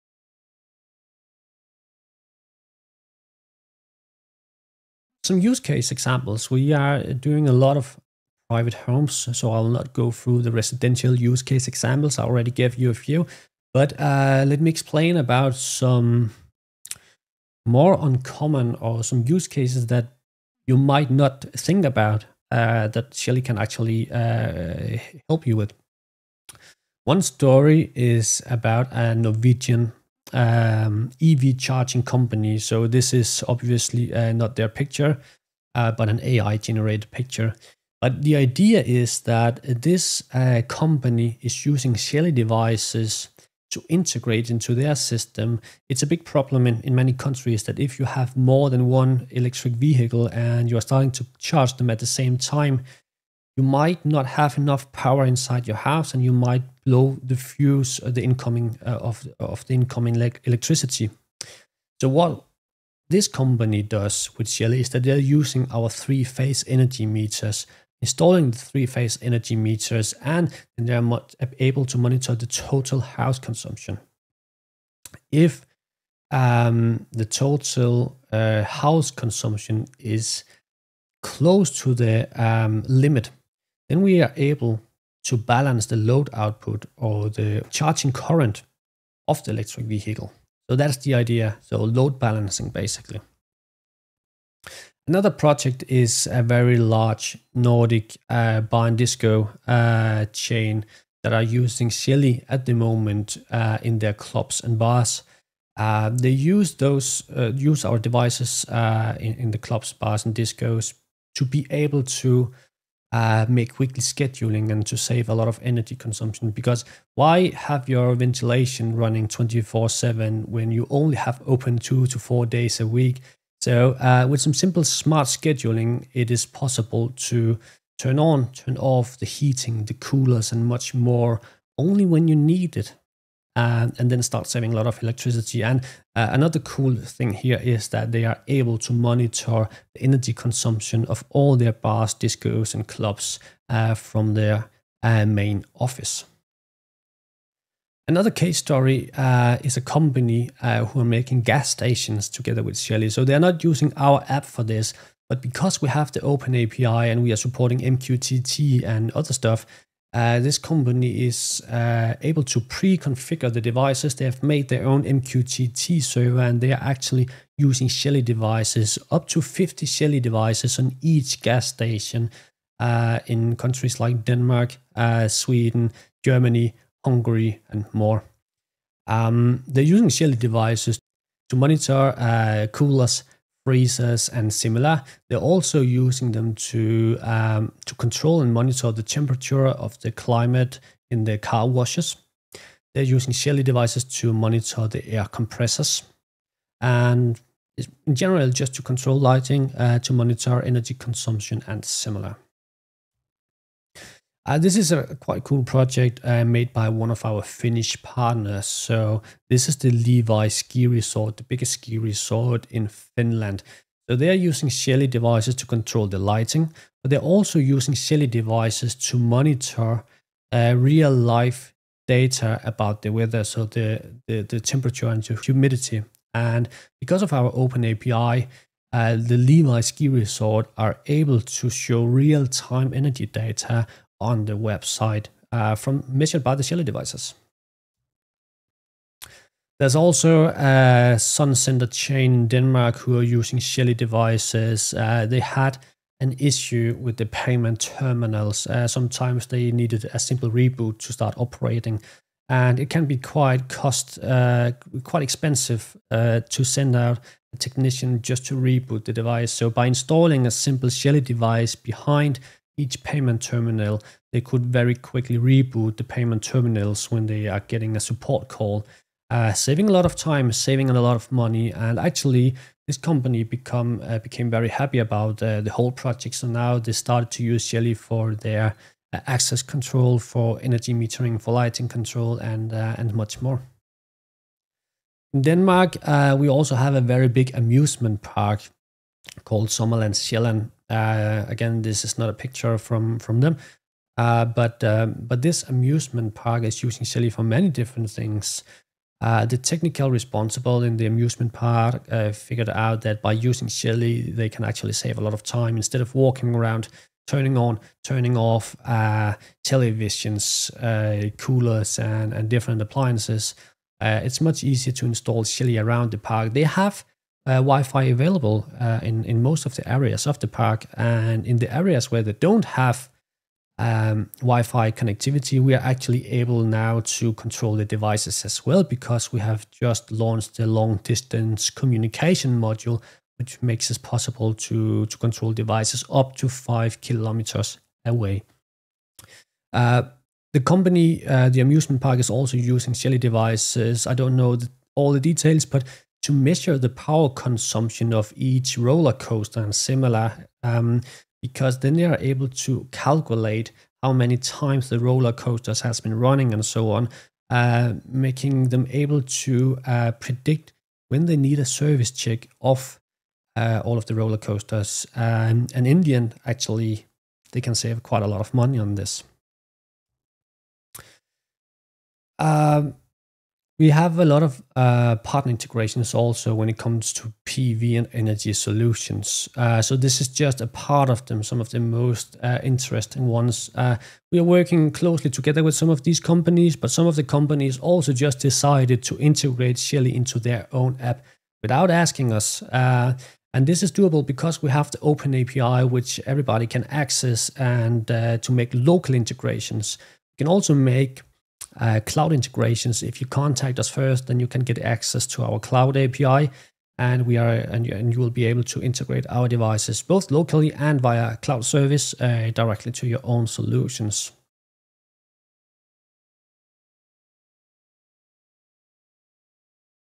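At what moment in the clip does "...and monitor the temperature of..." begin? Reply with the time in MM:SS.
03:08.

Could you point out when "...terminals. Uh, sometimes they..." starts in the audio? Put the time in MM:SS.
04:07.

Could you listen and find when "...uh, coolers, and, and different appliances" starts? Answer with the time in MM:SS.
05:10.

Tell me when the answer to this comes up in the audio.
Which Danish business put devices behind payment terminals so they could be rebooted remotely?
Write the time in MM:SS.
04:01.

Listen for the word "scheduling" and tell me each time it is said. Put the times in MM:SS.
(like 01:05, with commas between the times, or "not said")
01:54, 02:05.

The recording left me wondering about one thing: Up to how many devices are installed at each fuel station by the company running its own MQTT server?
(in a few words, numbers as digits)
50.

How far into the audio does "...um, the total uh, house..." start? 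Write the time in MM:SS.
01:16.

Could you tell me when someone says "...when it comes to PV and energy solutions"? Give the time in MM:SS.
06:16.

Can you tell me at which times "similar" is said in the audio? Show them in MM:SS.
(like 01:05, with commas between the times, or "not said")
03:04, 03:21, 05:49.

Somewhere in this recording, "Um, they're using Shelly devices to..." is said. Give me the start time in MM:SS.
02:59.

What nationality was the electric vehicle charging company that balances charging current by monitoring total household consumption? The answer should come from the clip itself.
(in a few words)
Norwegian.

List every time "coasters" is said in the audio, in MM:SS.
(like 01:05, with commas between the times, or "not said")
05:49, 05:55, 06:04.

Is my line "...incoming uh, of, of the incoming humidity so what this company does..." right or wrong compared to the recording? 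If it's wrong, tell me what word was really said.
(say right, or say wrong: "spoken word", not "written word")
wrong: "electricity", not "humidity".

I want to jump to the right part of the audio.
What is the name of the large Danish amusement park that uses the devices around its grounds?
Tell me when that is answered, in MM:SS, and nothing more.
04:49.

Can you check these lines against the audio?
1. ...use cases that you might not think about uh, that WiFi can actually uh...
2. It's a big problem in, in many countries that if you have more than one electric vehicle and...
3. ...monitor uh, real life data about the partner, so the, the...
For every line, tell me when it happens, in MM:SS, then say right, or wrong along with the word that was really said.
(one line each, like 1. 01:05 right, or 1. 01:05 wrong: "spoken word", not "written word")
1. 00:19 wrong: "Shelly", not "WiFi"
2. 00:45 right
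3. 03:39 wrong: "weather", not "partner".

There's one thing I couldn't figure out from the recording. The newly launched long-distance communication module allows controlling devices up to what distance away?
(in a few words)
5 kilometers.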